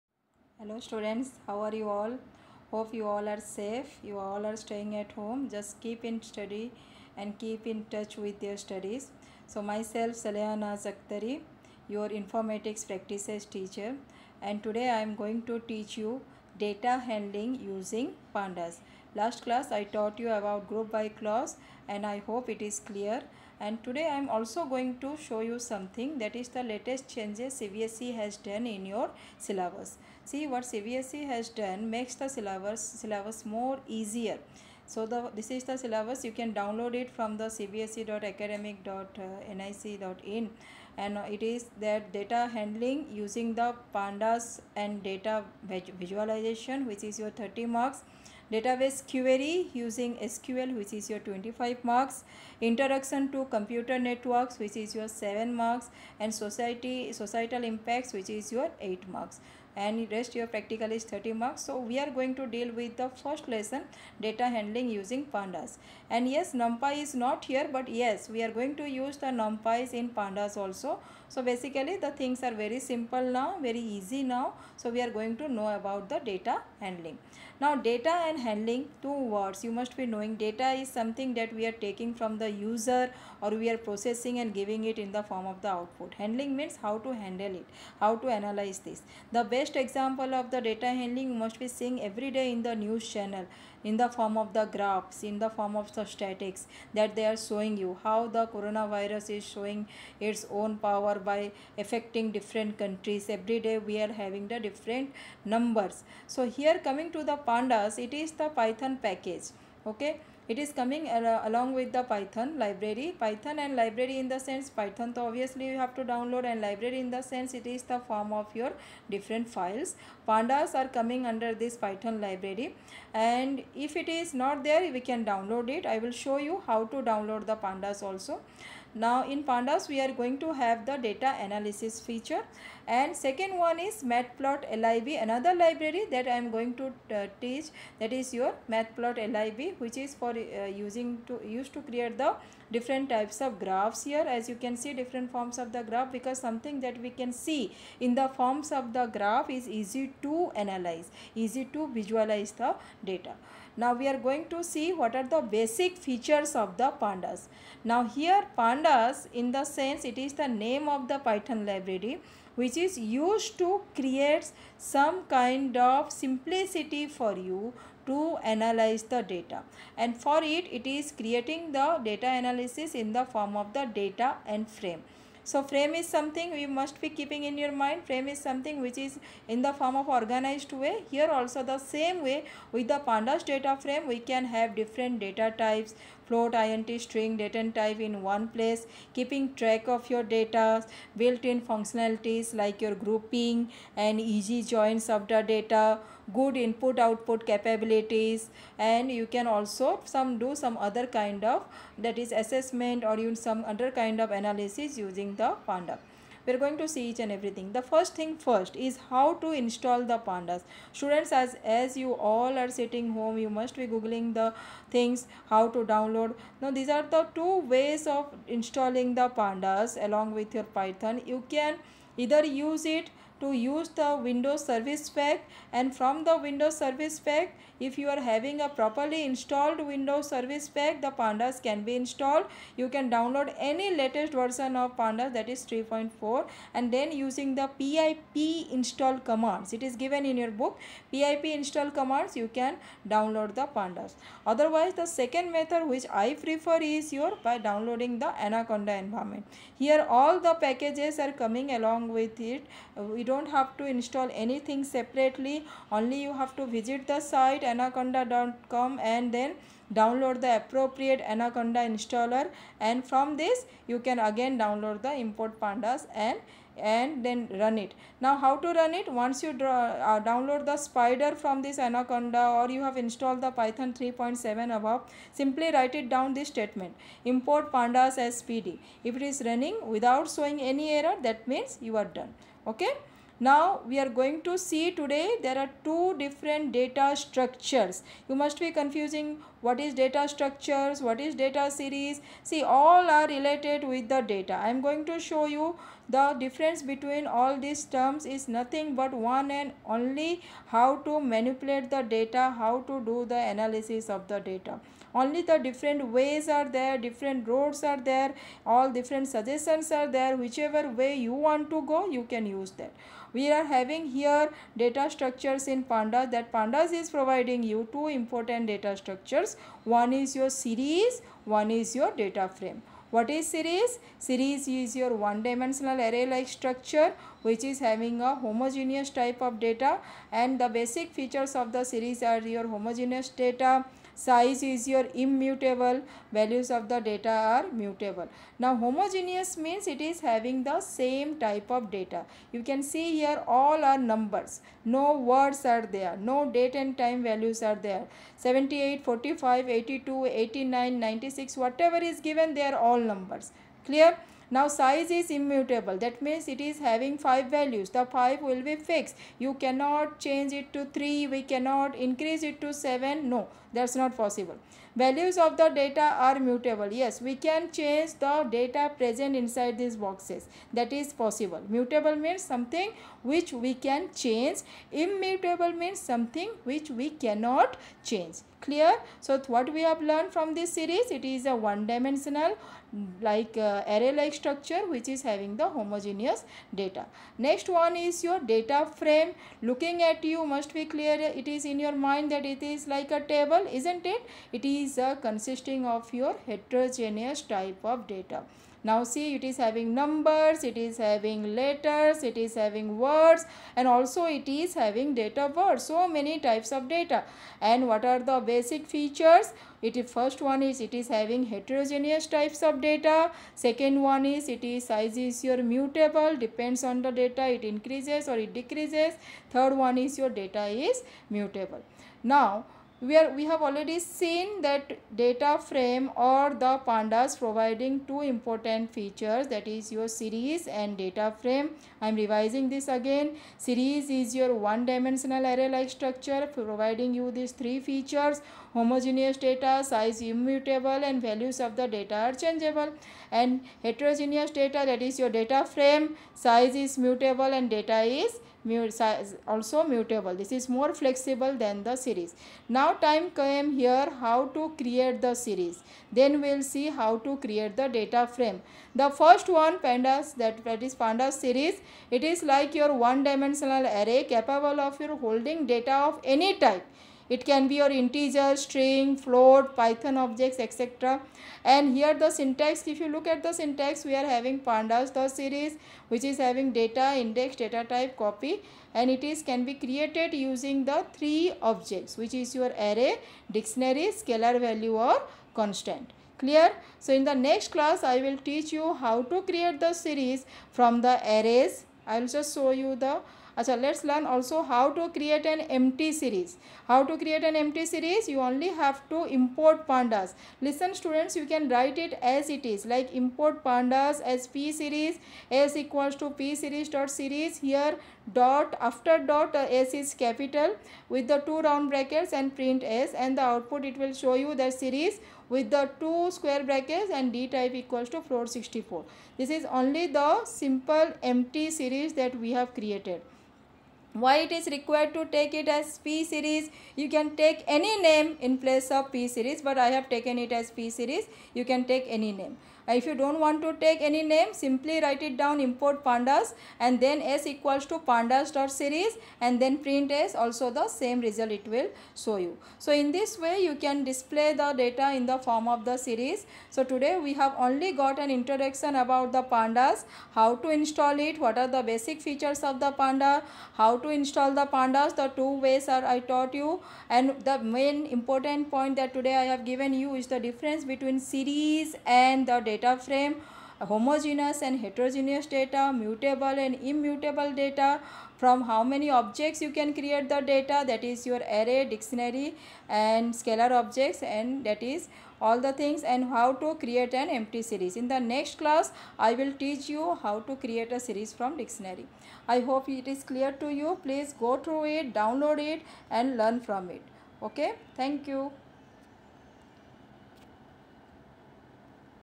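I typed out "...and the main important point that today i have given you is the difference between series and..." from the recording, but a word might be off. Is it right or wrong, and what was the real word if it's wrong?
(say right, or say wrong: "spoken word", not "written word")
right.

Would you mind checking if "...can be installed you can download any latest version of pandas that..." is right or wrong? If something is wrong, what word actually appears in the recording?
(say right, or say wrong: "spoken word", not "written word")
right.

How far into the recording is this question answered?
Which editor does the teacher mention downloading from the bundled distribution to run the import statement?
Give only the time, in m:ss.
4:30.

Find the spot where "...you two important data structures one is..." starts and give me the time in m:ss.
5:17.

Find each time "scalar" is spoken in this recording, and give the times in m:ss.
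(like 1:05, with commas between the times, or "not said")
8:04, 9:33.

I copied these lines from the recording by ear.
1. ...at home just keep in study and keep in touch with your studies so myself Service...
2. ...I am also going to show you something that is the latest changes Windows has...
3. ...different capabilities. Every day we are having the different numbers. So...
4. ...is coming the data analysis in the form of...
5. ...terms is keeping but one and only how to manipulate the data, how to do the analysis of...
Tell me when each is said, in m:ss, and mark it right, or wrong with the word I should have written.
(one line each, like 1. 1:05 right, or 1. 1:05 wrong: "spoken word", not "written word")
1. 0:04 wrong: "Salayana", not "Service"
2. 0:24 wrong: "CBSE", not "Windows"
3. 1:42 wrong: "countries", not "capabilities"
4. 2:50 wrong: "creating", not "coming"
5. 4:57 wrong: "nothing", not "keeping".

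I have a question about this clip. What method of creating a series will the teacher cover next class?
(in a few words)
from dictionary.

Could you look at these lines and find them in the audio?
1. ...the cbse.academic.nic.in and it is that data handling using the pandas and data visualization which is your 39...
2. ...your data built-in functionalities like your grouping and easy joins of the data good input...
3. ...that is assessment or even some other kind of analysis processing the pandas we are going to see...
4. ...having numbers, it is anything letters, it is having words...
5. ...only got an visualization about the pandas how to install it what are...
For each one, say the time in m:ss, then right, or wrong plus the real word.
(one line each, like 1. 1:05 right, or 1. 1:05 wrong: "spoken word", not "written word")
1. 0:37 wrong: "30", not "39"
2. 3:10 right
3. 3:22 wrong: "using", not "processing"
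4. 6:39 wrong: "having", not "anything"
5. 9:07 wrong: "introduction", not "visualization".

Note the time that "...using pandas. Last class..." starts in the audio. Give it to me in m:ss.
0:17.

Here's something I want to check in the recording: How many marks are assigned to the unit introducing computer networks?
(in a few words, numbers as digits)
7.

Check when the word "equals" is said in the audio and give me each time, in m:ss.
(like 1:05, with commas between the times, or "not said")
8:25, 8:37, 8:57.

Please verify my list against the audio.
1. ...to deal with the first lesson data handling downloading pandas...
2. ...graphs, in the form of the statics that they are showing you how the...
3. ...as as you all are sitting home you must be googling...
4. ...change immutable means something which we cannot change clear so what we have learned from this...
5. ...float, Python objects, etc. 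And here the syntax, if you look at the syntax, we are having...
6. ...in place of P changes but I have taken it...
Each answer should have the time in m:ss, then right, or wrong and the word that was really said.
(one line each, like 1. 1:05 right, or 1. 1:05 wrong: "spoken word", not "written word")
1. 1:02 wrong: "using", not "downloading"
2. 1:34 right
3. 3:31 right
4. 6:14 right
5. 7:49 right
6. 8:48 wrong: "series", not "changes".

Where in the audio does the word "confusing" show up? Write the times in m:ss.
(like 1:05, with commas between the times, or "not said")
4:48.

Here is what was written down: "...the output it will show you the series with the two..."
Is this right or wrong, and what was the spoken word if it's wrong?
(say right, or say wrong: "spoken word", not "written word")
right.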